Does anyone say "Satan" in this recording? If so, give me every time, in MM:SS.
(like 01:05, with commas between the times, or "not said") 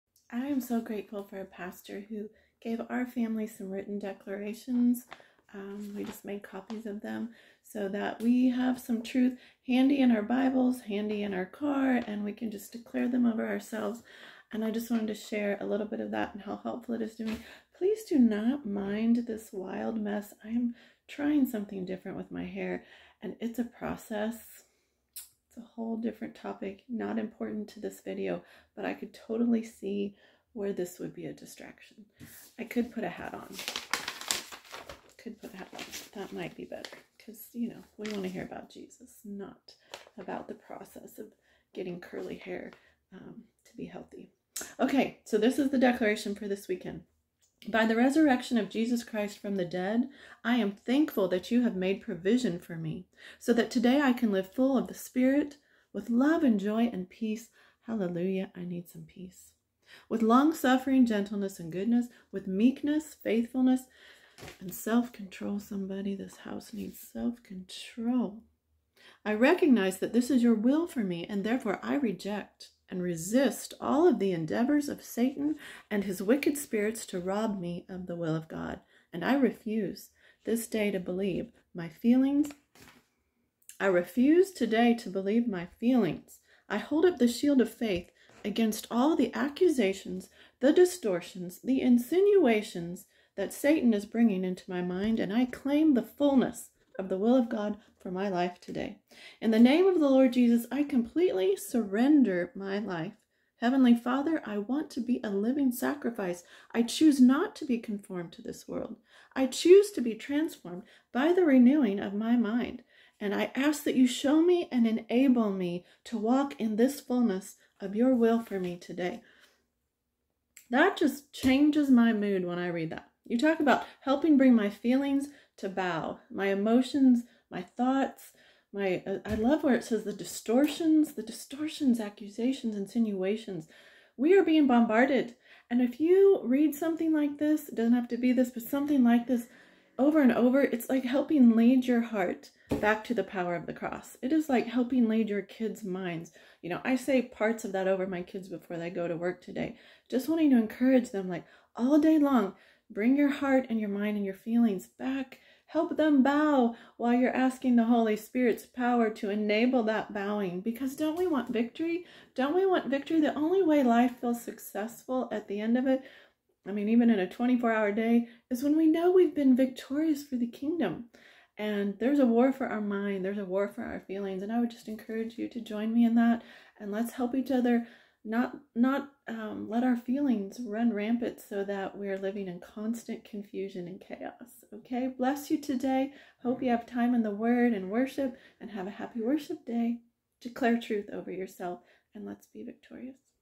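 01:15, 01:33.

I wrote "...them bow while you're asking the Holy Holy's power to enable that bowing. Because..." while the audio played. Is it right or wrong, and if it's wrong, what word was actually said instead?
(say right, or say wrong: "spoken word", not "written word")
wrong: "Spirit", not "Holy".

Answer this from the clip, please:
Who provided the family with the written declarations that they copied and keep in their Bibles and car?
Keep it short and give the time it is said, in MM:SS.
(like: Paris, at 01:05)
A pastor, at 00:01.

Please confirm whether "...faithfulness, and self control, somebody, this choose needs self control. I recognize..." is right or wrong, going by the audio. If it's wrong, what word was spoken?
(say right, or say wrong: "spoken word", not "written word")
wrong: "house", not "choose".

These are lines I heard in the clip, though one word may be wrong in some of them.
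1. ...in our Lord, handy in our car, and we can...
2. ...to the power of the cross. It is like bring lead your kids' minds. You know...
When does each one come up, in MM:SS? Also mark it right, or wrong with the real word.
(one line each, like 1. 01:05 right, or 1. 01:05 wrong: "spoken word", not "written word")
1. 00:09 wrong: "Bibles", not "Lord"
2. 02:23 wrong: "helping", not "bring".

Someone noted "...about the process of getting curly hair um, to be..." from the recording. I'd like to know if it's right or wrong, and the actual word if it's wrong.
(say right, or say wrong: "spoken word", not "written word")
right.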